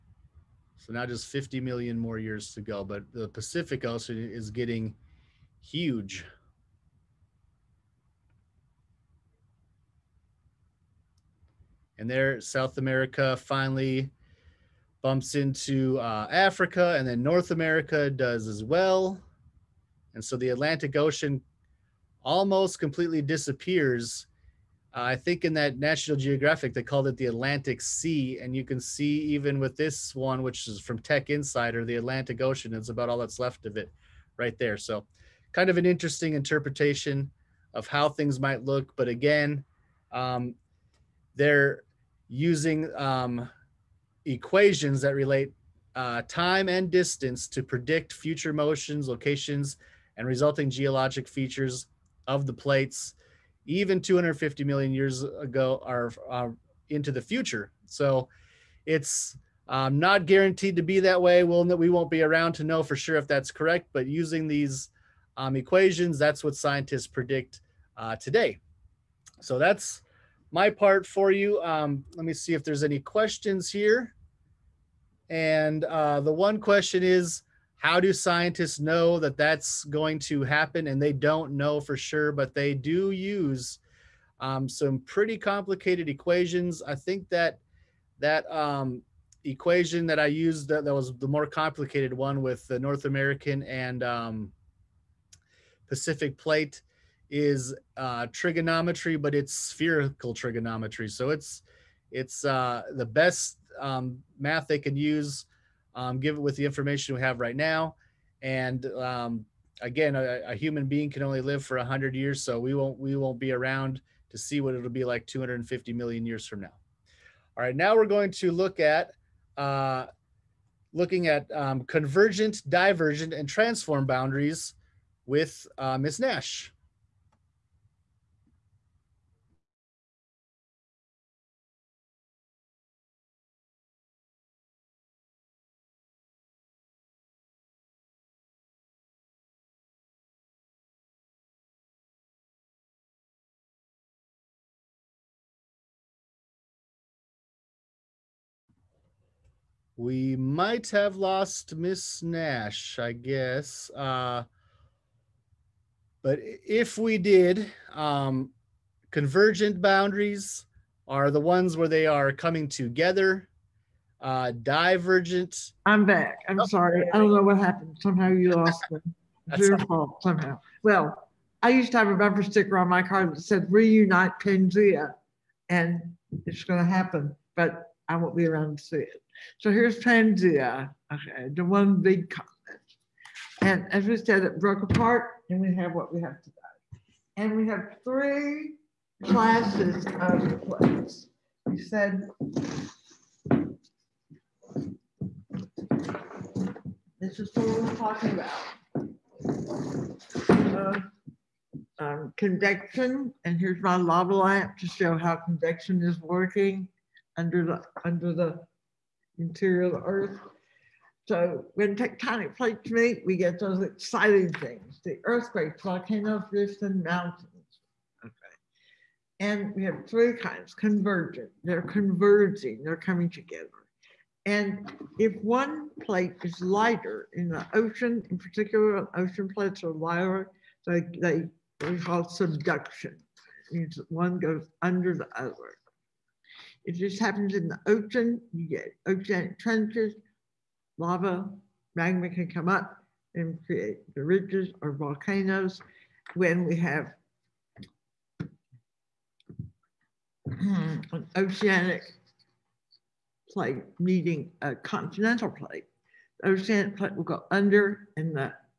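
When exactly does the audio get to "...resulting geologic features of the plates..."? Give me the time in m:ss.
0:50.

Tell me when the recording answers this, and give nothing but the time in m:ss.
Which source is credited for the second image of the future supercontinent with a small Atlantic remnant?
0:30.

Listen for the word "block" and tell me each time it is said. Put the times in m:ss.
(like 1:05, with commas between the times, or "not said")
not said.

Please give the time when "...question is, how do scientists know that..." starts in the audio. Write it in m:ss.
1:16.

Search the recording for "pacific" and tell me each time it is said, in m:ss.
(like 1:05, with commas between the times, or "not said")
0:03, 1:35.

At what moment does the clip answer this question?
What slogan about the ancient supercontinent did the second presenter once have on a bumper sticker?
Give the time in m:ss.
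2:53.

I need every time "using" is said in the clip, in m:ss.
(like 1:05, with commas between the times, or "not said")
0:42, 1:04.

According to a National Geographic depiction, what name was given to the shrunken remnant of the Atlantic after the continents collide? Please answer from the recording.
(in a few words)
Atlantic Sea.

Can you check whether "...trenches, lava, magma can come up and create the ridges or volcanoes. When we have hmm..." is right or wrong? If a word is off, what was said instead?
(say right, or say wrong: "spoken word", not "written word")
right.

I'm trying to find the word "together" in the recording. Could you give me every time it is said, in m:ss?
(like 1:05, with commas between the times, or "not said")
2:42, 3:43.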